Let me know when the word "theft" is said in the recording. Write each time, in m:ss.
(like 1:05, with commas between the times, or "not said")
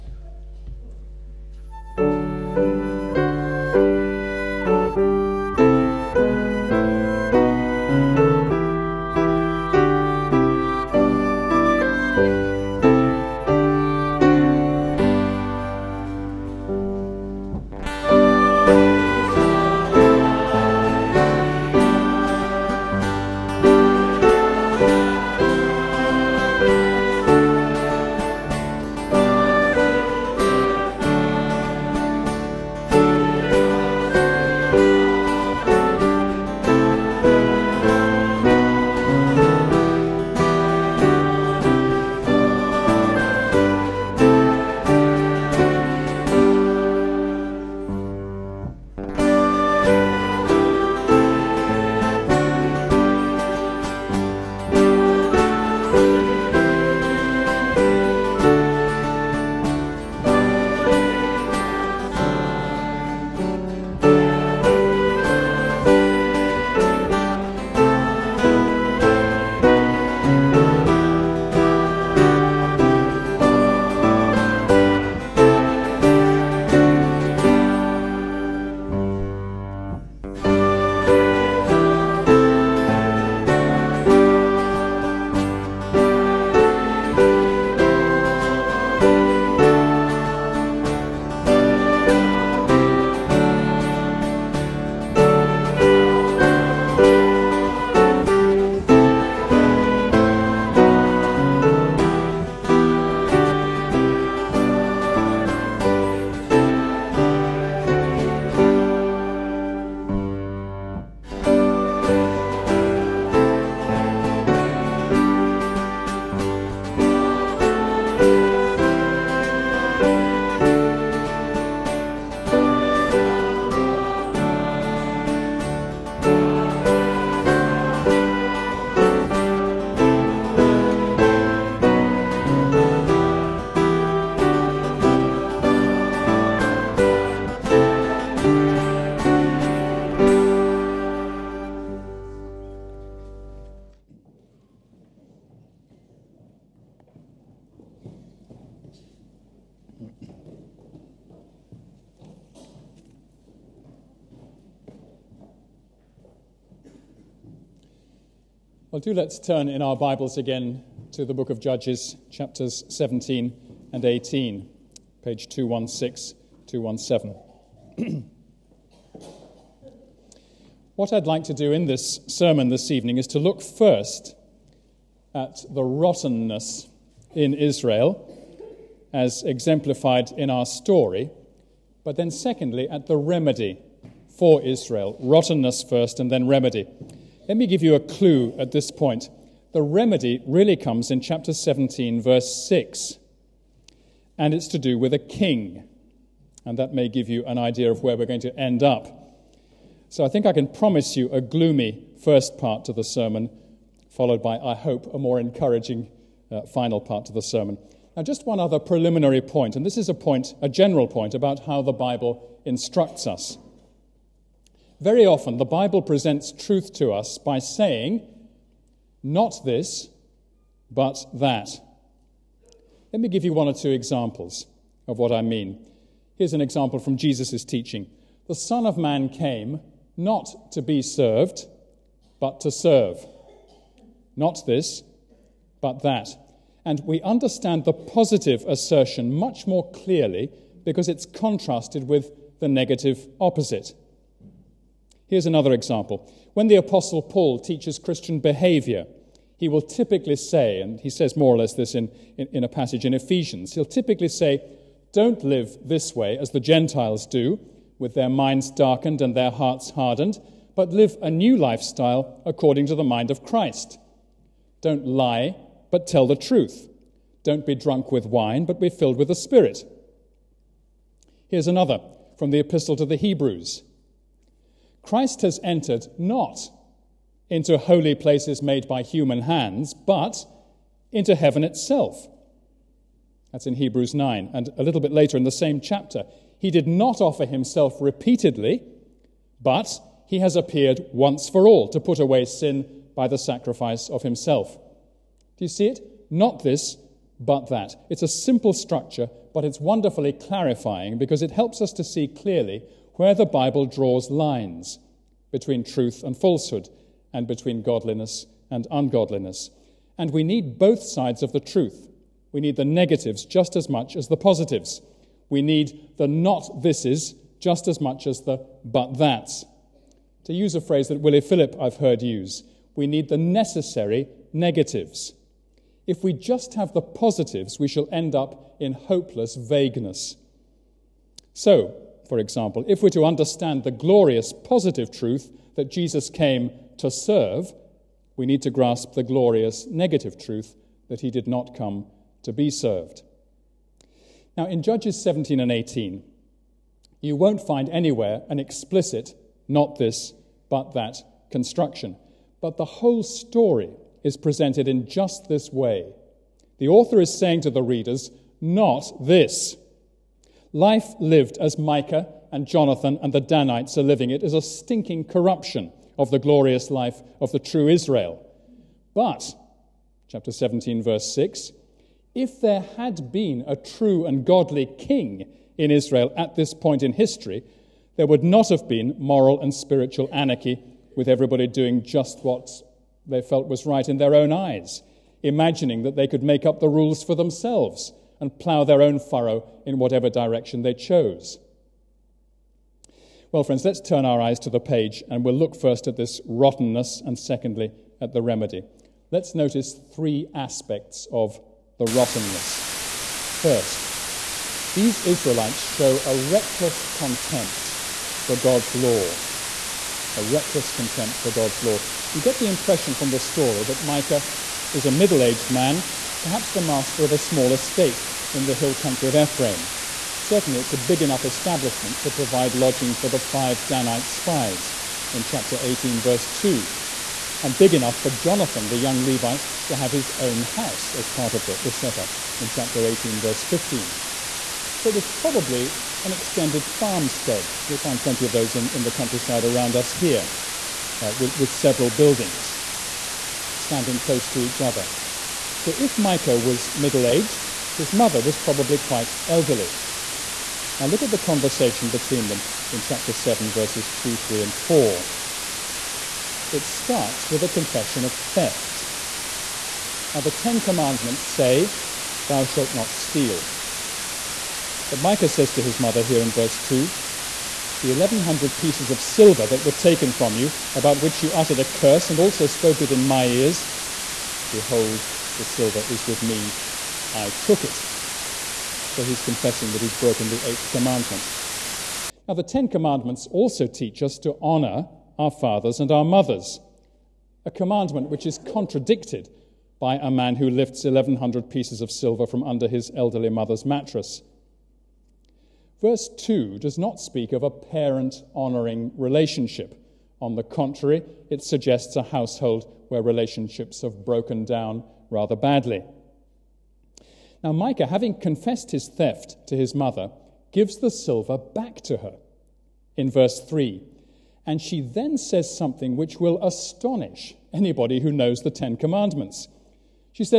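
7:38, 8:29.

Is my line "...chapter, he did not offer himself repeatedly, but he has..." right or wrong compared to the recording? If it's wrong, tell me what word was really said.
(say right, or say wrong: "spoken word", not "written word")
right.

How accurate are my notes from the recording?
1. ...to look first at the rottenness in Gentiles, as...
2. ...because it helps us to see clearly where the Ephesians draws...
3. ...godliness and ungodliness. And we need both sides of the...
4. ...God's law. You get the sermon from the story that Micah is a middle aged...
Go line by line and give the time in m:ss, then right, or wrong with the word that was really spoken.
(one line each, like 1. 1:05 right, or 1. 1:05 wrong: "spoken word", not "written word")
1. 2:53 wrong: "Israel", not "Gentiles"
2. 5:01 wrong: "Bible", not "Ephesians"
3. 5:07 right
4. 6:51 wrong: "impression", not "sermon".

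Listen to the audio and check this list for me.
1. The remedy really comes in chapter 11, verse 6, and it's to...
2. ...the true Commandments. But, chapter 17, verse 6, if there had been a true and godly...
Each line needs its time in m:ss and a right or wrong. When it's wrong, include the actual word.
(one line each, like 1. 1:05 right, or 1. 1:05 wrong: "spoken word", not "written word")
1. 3:09 wrong: "17", not "11"
2. 6:07 wrong: "Israel", not "Commandments".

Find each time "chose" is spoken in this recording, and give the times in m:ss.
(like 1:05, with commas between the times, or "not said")
6:30.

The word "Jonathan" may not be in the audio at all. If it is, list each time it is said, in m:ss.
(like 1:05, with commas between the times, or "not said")
6:02, 7:08.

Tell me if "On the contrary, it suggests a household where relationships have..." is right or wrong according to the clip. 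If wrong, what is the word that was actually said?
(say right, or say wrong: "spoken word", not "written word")
right.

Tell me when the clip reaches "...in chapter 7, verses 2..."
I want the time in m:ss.
7:32.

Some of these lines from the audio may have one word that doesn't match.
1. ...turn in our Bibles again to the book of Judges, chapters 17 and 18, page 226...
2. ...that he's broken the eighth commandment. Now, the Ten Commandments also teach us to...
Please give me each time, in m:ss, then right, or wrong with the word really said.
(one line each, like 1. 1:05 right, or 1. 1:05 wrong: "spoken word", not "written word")
1. 2:39 wrong: "216", not "226"
2. 7:59 right.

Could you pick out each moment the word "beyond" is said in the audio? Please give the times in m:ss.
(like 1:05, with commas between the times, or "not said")
not said.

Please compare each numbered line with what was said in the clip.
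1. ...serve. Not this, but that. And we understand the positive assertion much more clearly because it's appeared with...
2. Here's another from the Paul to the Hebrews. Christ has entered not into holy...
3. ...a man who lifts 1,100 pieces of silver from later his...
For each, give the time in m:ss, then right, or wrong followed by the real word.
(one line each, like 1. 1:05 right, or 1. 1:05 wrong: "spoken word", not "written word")
1. 3:52 wrong: "contrasted", not "appeared"
2. 4:31 wrong: "Epistle", not "Paul"
3. 8:10 wrong: "under", not "later".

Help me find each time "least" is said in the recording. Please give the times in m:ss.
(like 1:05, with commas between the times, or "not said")
not said.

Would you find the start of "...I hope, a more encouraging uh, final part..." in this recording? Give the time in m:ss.
3:24.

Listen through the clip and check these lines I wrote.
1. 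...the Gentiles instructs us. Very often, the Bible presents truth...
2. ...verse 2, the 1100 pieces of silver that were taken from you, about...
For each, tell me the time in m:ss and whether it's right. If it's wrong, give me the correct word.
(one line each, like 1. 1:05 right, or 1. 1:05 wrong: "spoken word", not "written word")
1. 3:31 wrong: "Bible", not "Gentiles"
2. 7:46 right.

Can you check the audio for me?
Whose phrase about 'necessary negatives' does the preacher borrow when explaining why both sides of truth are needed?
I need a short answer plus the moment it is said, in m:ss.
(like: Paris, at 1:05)
Willie Philip, at 5:21.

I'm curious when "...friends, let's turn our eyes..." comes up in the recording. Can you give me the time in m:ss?
6:33.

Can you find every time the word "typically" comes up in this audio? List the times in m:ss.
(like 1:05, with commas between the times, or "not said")
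4:09, 4:13.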